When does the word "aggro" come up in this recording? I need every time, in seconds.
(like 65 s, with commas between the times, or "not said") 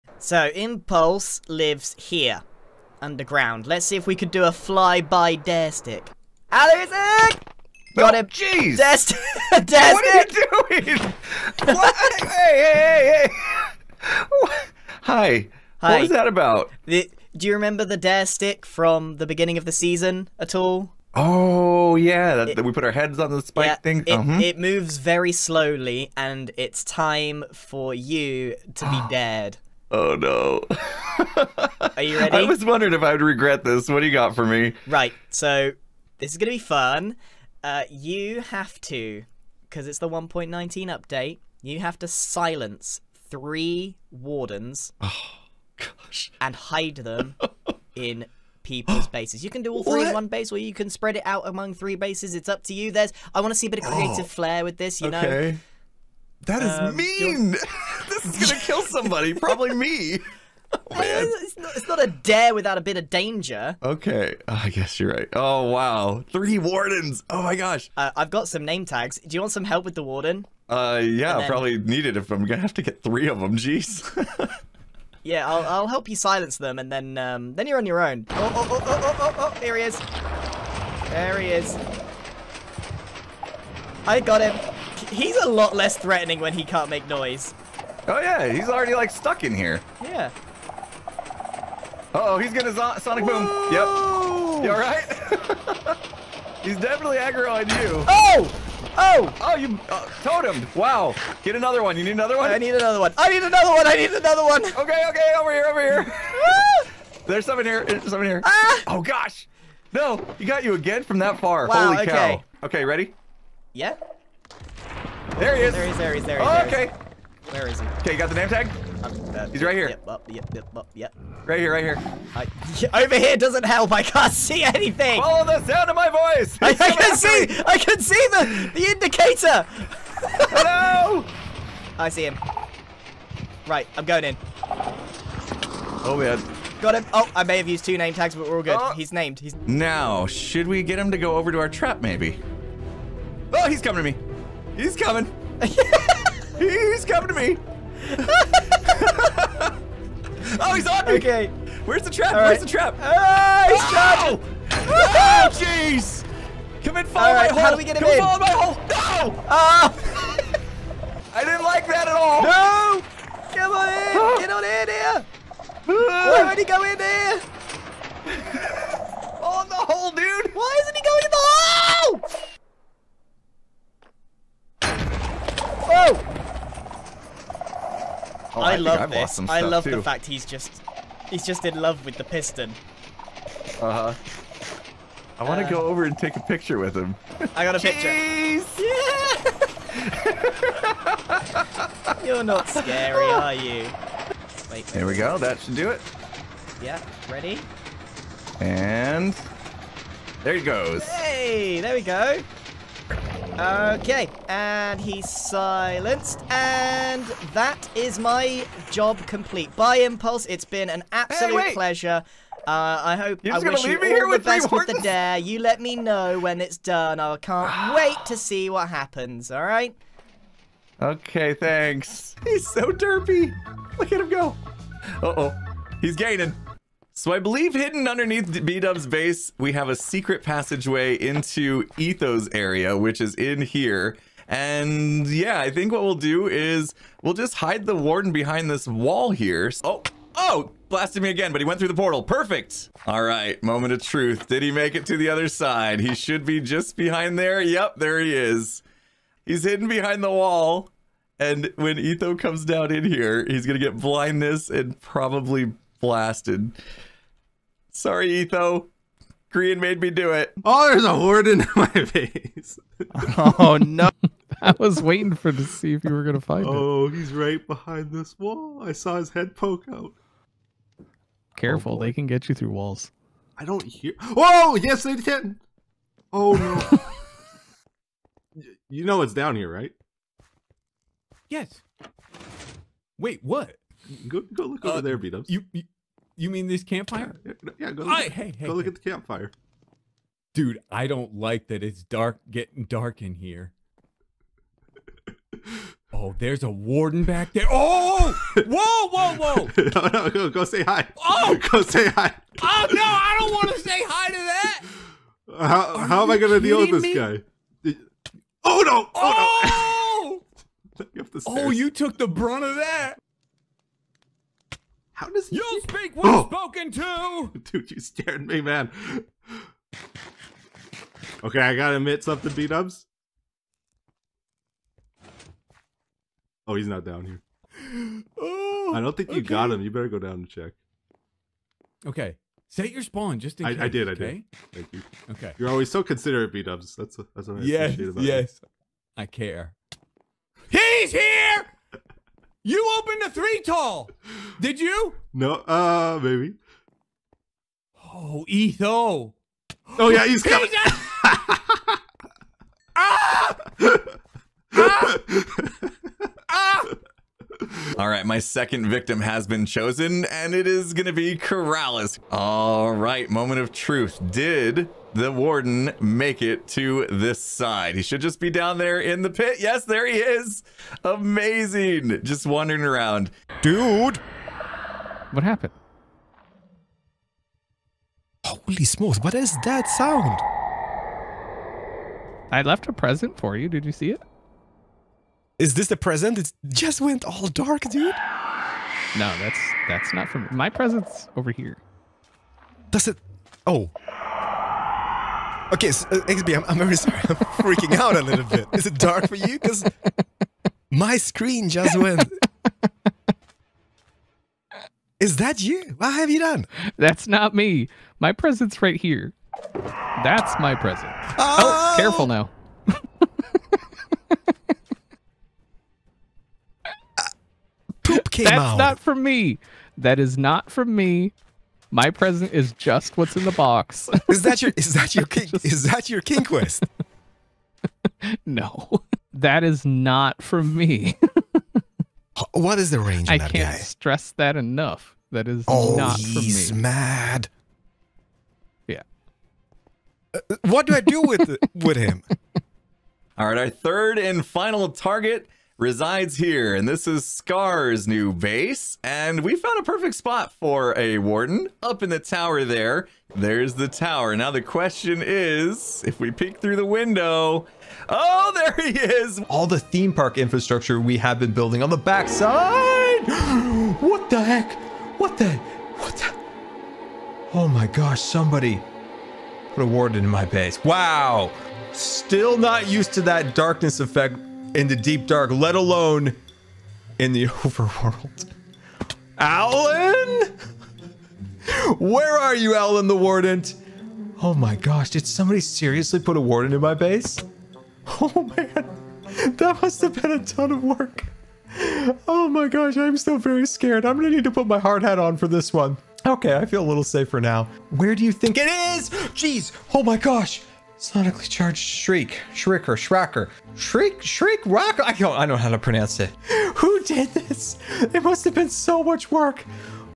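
97 s.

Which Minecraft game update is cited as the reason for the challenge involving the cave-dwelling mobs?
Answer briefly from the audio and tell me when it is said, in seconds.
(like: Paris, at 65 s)
1.19, at 40 s.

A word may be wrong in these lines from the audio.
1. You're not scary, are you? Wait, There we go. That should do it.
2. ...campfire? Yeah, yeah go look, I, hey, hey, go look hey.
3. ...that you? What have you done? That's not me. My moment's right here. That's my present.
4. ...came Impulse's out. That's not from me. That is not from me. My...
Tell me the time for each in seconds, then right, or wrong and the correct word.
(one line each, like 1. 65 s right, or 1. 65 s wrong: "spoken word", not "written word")
1. 192 s right
2. 286 s right
3. 405 s wrong: "present", not "moment"
4. 418 s wrong: "That", not "Impulse".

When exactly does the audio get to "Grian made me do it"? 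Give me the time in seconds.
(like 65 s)
259 s.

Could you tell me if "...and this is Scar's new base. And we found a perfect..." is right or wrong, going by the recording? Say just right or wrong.
right.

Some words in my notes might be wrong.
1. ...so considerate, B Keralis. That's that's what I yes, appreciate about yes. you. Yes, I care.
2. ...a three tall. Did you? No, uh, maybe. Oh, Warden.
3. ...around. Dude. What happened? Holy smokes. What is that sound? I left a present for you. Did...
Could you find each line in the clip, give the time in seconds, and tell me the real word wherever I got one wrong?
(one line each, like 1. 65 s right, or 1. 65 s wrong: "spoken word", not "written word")
1. 335 s wrong: "Dubs", not "Keralis"
2. 343 s wrong: "Etho", not "Warden"
3. 372 s right.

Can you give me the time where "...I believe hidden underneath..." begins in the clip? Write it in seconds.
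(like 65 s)
227 s.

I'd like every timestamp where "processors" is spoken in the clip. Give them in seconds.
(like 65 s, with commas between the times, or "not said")
not said.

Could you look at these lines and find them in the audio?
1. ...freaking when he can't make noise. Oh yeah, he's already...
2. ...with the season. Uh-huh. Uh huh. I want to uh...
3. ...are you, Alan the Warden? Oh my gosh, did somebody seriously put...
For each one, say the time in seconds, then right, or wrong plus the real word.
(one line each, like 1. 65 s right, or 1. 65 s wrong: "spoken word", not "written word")
1. 85 s wrong: "threatening", not "freaking"
2. 182 s wrong: "piston", not "season"
3. 482 s right.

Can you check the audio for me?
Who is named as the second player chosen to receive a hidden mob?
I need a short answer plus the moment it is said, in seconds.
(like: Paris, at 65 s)
Keralis, at 361 s.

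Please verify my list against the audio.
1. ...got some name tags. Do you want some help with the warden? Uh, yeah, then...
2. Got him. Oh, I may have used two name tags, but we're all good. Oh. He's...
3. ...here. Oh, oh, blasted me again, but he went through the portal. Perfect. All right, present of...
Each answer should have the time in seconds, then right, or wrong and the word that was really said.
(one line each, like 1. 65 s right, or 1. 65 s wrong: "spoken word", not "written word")
1. 68 s right
2. 136 s right
3. 239 s wrong: "moment", not "present".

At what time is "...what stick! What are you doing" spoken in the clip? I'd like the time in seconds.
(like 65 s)
9 s.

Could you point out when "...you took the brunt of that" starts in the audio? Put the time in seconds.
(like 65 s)
311 s.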